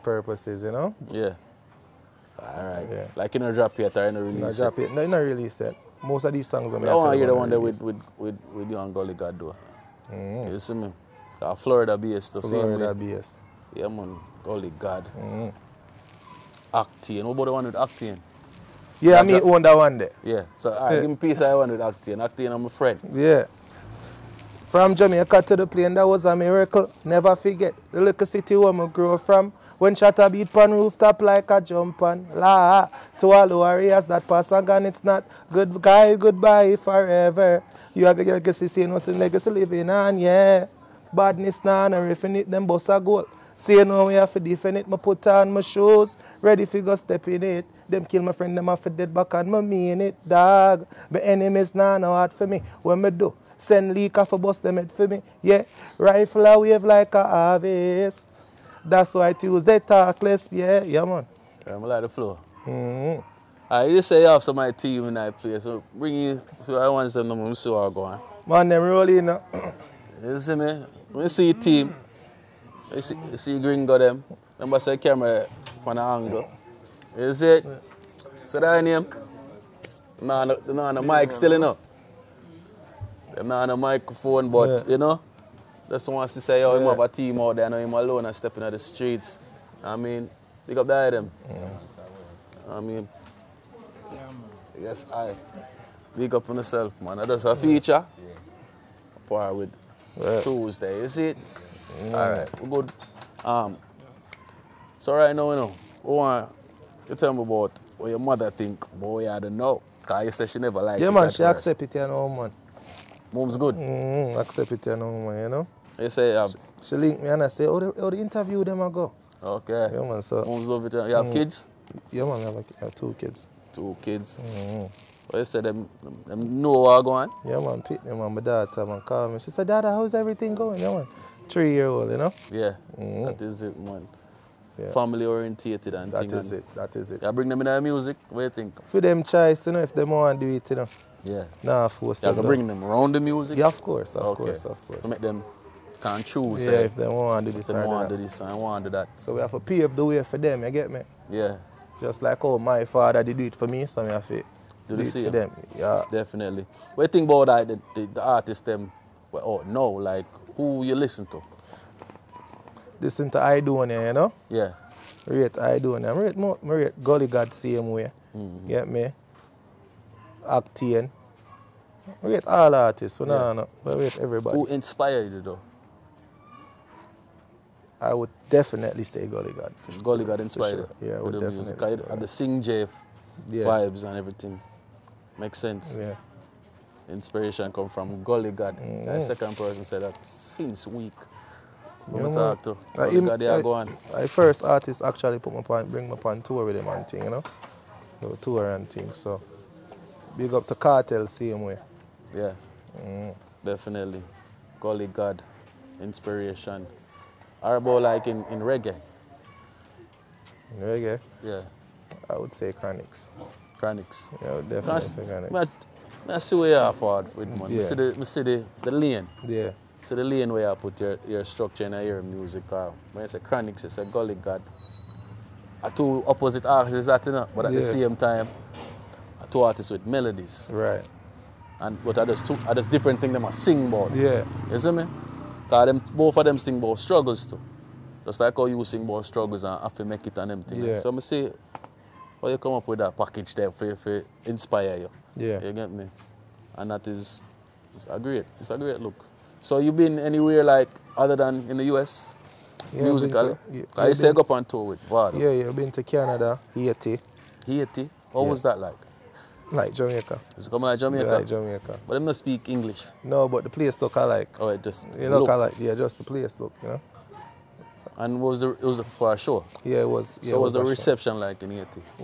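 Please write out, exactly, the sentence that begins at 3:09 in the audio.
The second person said that since week.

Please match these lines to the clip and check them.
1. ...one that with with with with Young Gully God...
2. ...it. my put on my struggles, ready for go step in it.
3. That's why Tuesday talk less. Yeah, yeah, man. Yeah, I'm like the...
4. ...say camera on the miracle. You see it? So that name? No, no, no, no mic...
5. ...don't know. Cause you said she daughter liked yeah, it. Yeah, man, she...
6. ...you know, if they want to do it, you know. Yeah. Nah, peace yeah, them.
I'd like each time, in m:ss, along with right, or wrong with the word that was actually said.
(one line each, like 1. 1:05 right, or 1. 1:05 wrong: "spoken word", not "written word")
1. 0:07 right
2. 0:44 wrong: "shoes", not "struggles"
3. 0:58 right
4. 1:14 wrong: "angle", not "miracle"
5. 1:49 wrong: "never", not "daughter"
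6. 2:19 wrong: "force", not "peace".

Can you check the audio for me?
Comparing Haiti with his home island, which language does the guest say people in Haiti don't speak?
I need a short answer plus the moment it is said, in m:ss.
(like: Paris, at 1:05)
English, at 4:22.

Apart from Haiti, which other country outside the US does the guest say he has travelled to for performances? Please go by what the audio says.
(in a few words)
Canada.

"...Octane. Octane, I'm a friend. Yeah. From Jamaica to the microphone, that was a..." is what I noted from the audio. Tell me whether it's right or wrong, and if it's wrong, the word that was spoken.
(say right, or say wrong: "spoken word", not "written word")
wrong: "plane", not "microphone".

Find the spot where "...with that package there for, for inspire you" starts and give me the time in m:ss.
4:02.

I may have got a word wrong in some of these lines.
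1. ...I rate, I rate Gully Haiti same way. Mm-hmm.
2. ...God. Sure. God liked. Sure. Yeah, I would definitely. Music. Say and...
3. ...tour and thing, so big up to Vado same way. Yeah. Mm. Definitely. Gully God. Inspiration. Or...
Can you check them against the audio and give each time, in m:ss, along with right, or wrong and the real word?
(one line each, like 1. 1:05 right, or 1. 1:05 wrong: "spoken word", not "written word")
1. 2:45 wrong: "God", not "Haiti"
2. 2:59 wrong: "inspired", not "liked"
3. 3:18 wrong: "Kartel", not "Vado".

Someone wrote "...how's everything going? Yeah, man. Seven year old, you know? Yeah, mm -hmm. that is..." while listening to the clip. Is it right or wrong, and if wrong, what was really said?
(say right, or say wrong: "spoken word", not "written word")
wrong: "Three", not "Seven".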